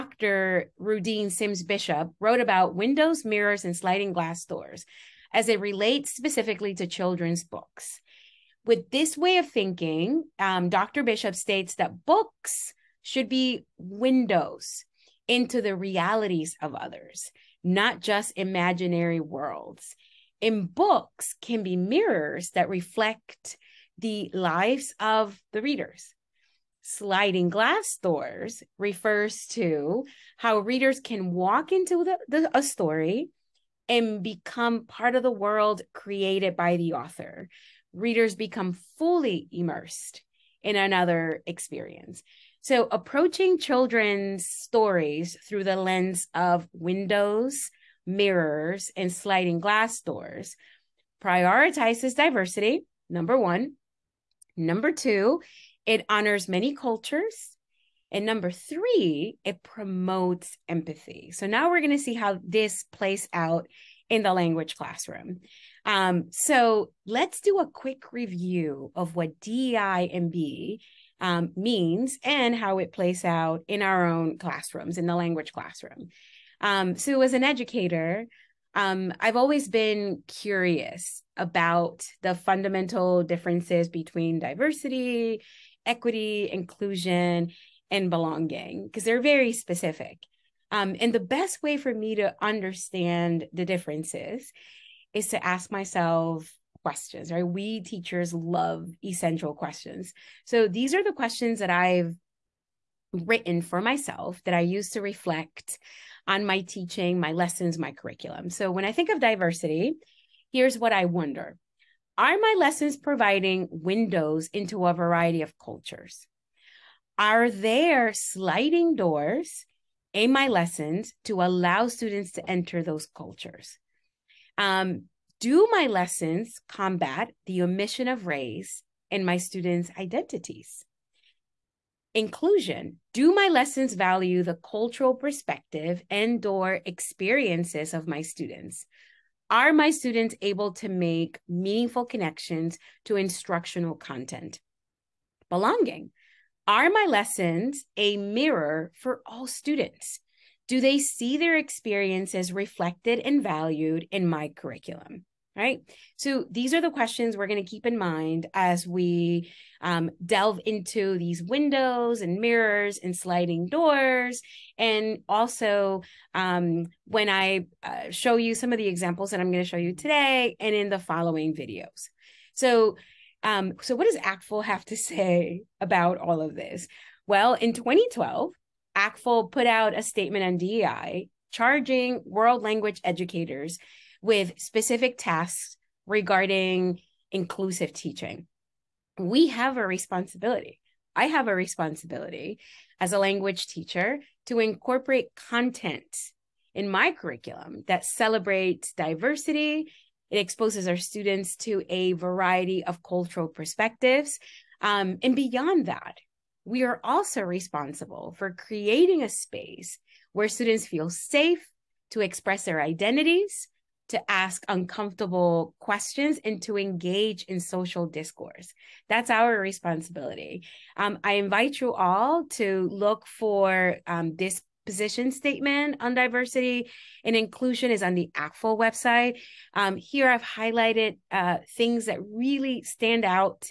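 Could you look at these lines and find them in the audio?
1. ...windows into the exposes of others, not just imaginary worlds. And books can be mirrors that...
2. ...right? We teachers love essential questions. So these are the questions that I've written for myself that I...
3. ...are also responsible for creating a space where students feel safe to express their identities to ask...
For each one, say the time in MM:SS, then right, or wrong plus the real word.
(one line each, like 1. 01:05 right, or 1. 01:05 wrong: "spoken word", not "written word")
1. 00:13 wrong: "realities", not "exposes"
2. 01:37 right
3. 03:26 right.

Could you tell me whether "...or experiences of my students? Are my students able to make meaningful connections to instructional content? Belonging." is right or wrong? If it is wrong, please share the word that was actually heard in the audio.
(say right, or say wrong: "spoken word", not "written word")
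right.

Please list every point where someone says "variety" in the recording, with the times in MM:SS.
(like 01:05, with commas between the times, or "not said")
01:54, 03:22.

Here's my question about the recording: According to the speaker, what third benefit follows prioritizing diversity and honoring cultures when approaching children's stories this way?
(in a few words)
Promotes empathy.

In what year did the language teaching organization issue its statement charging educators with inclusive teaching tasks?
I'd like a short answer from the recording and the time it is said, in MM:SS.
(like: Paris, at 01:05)
2012, at 02:57.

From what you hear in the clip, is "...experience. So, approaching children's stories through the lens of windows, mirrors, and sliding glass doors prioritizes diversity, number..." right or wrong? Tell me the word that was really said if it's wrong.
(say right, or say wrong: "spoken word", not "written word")
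right.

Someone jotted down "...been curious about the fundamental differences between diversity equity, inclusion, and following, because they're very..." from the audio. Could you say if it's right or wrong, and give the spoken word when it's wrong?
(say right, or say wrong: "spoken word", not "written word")
wrong: "belonging", not "following".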